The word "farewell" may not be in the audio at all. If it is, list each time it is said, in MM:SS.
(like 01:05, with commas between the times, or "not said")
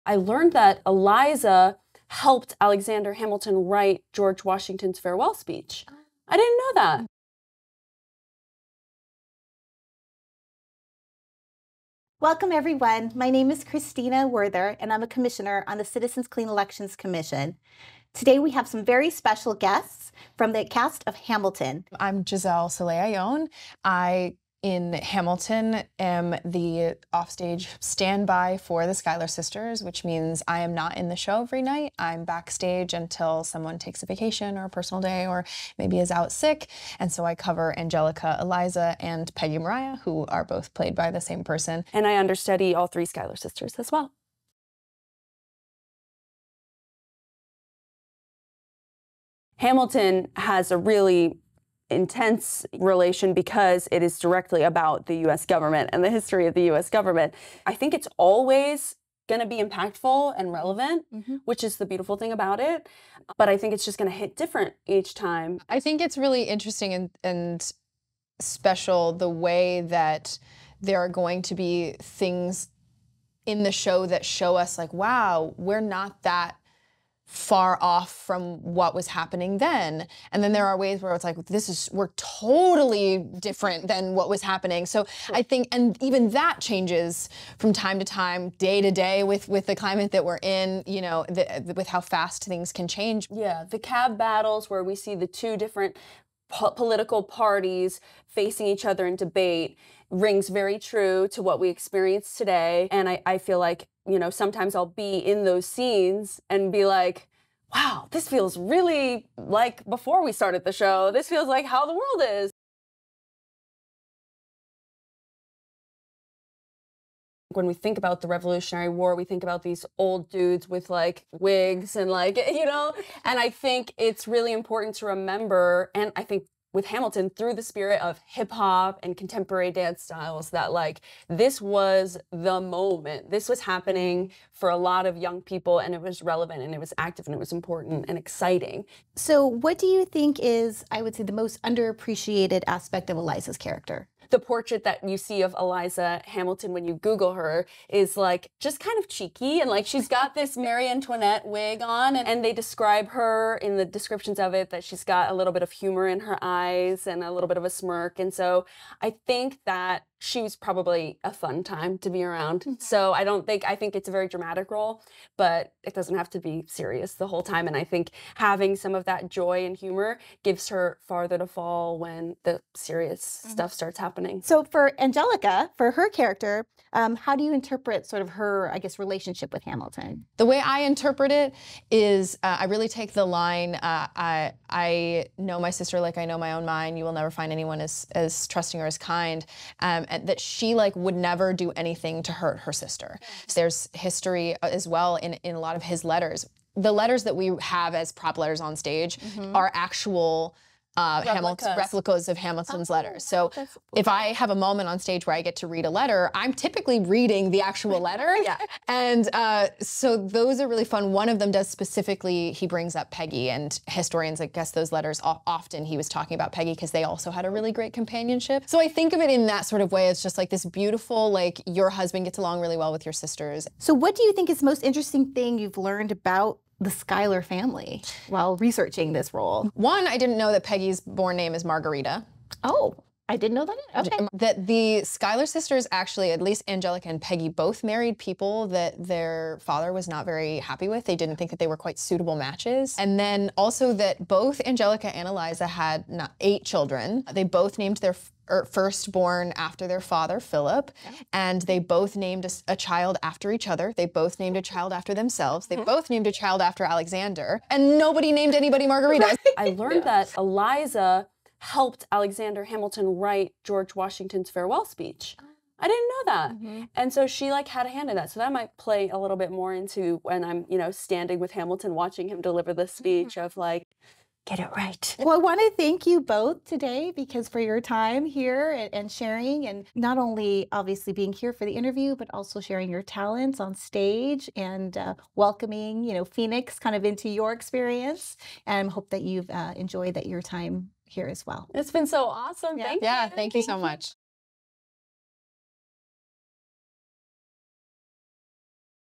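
00:04, 04:24.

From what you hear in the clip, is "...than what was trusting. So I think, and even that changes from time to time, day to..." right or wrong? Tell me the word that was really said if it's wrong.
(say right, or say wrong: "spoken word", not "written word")
wrong: "happening", not "trusting".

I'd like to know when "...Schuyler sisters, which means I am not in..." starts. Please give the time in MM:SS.
00:28.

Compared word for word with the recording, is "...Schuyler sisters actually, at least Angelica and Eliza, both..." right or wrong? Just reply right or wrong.
wrong.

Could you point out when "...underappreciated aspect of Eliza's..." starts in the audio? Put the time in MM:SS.
02:21.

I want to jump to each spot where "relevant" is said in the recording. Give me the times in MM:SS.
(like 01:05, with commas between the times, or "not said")
01:00, 02:16.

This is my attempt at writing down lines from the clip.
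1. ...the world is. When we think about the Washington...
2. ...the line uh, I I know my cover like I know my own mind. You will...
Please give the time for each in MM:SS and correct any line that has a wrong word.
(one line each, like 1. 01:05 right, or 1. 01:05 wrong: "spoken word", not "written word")
1. 01:51 wrong: "Revolutionary", not "Washington"
2. 03:03 wrong: "sister", not "cover".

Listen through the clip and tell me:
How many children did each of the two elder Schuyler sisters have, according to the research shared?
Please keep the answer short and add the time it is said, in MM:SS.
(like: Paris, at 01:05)
8, at 04:06.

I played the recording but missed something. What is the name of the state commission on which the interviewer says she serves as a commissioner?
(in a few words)
Citizens Clean Elections Commission.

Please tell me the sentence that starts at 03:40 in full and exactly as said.
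It's just like this beautiful, like your husband gets along really well with your sisters.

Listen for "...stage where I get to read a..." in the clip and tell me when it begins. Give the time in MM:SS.
03:24.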